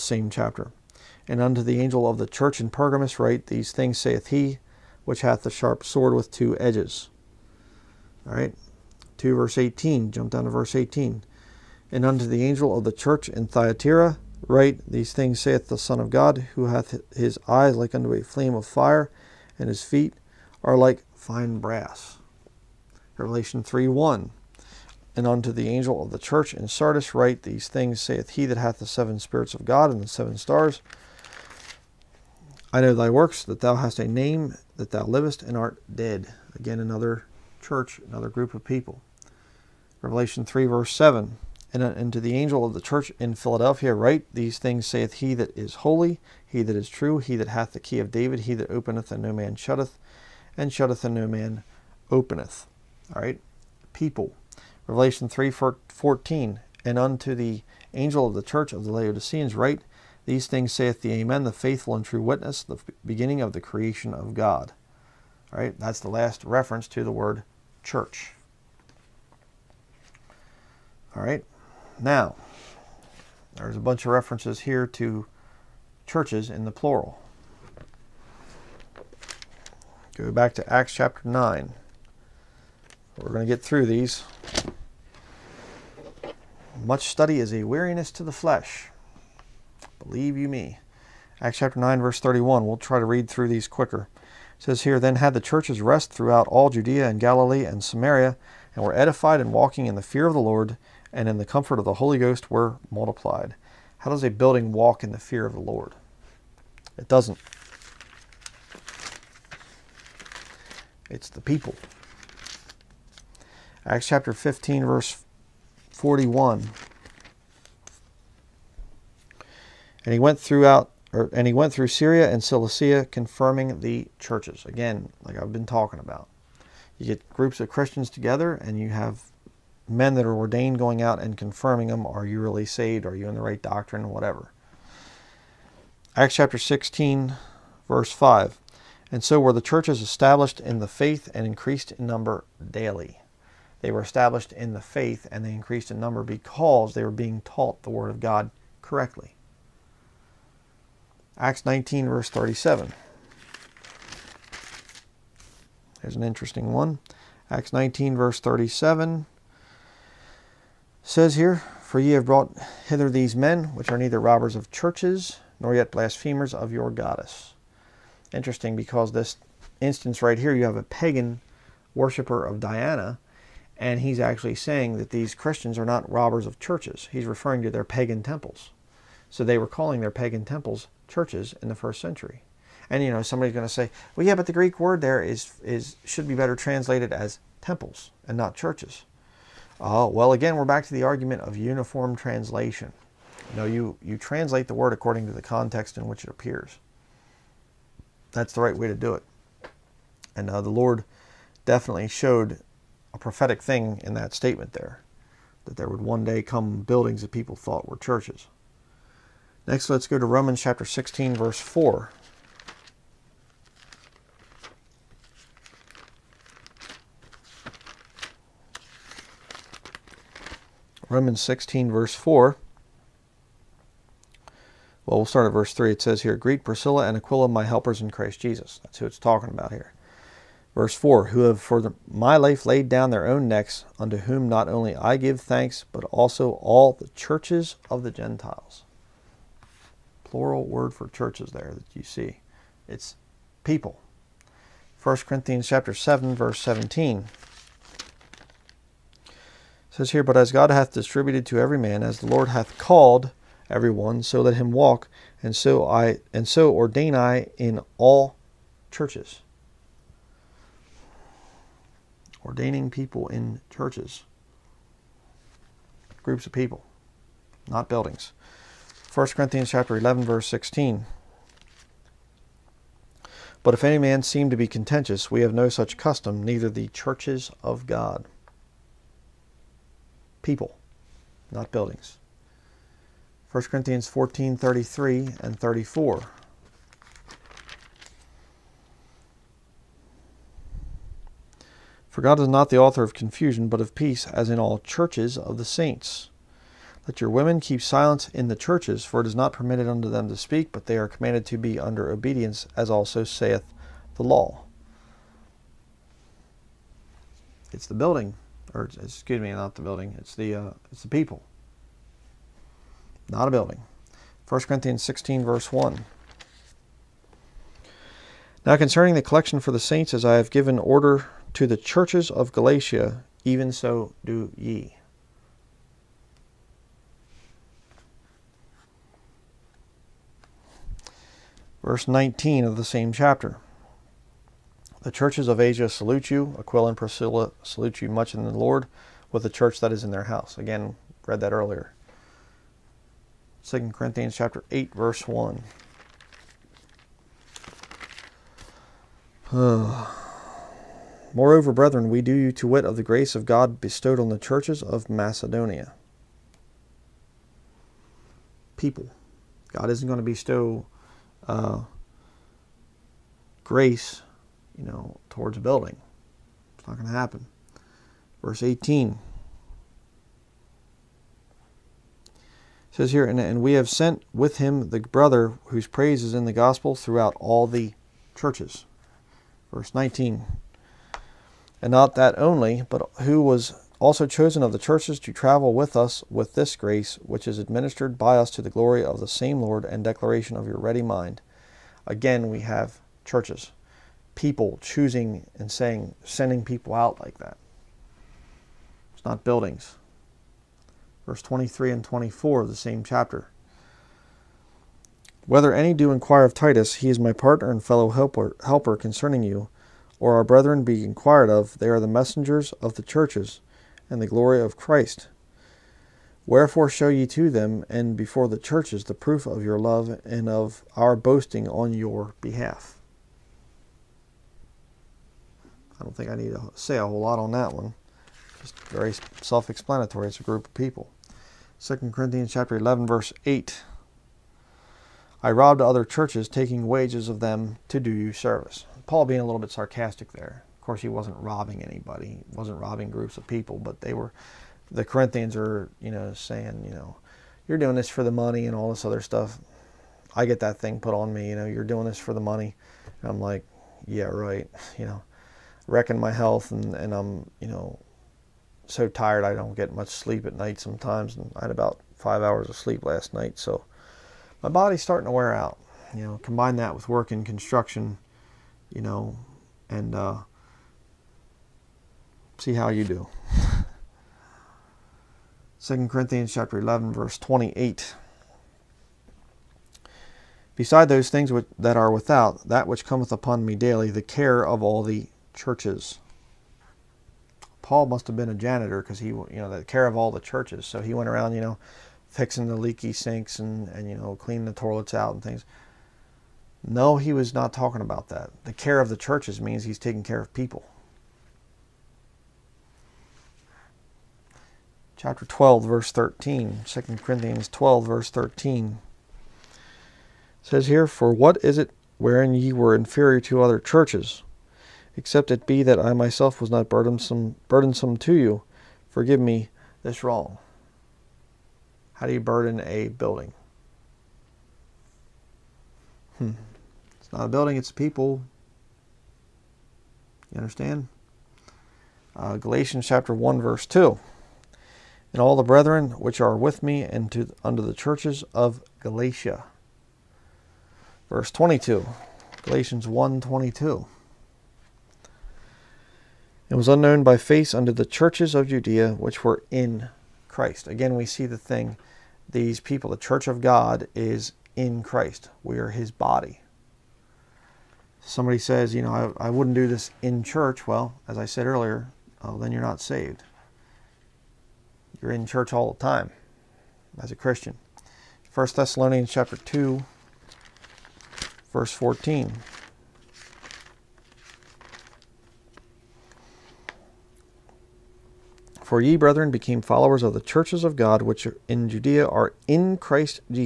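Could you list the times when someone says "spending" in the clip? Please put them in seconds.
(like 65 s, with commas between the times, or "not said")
not said.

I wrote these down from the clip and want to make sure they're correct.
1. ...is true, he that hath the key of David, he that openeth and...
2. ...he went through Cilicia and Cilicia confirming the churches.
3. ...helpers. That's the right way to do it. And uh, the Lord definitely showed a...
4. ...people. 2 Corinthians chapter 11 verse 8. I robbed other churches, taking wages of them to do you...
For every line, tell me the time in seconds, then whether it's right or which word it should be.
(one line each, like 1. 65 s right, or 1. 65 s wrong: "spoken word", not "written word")
1. 46 s right
2. 121 s wrong: "Syria", not "Cilicia"
3. 196 s wrong: "appears", not "helpers"
4. 430 s right.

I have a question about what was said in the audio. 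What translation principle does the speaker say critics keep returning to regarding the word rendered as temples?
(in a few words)
Uniform translation.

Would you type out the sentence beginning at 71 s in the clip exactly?
All right, now there's a bunch of references here to churches in the plural.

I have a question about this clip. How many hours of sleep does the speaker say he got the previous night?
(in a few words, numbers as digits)
5.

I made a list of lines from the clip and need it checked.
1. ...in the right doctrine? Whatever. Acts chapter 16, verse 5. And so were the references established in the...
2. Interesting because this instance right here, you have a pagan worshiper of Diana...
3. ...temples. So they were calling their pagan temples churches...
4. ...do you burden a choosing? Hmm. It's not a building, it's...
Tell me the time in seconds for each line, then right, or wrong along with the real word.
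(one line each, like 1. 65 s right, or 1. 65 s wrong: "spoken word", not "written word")
1. 133 s wrong: "churches", not "references"
2. 168 s right
3. 178 s right
4. 522 s wrong: "building", not "choosing".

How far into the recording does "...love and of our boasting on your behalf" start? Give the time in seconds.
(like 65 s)
419 s.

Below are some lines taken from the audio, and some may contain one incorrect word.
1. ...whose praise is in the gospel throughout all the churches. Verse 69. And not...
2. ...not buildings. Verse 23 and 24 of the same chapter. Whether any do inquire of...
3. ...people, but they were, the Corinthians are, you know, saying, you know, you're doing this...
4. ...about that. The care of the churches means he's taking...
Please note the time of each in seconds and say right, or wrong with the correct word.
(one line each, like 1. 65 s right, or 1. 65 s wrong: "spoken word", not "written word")
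1. 375 s wrong: "19", not "69"
2. 399 s right
3. 443 s right
4. 498 s right.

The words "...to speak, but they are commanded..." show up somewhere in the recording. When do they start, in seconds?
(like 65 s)
300 s.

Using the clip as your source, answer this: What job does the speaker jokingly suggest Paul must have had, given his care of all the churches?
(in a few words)
Janitor.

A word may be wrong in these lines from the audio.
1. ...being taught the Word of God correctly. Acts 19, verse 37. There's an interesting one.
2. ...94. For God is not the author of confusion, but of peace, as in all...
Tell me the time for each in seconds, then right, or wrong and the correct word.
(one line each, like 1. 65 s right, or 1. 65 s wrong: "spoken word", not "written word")
1. 147 s right
2. 285 s wrong: "34", not "94".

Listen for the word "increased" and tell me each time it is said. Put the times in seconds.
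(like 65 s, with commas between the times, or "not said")
141 s, 145 s.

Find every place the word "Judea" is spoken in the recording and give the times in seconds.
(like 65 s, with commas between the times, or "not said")
96 s, 548 s, 581 s.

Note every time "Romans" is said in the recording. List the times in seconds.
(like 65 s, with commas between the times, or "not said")
210 s, 221 s.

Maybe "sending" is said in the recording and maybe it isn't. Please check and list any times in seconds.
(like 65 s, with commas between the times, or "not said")
396 s.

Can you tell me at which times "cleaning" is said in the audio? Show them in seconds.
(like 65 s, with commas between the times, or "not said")
494 s.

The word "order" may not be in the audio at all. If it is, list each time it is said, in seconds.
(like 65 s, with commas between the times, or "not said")
320 s.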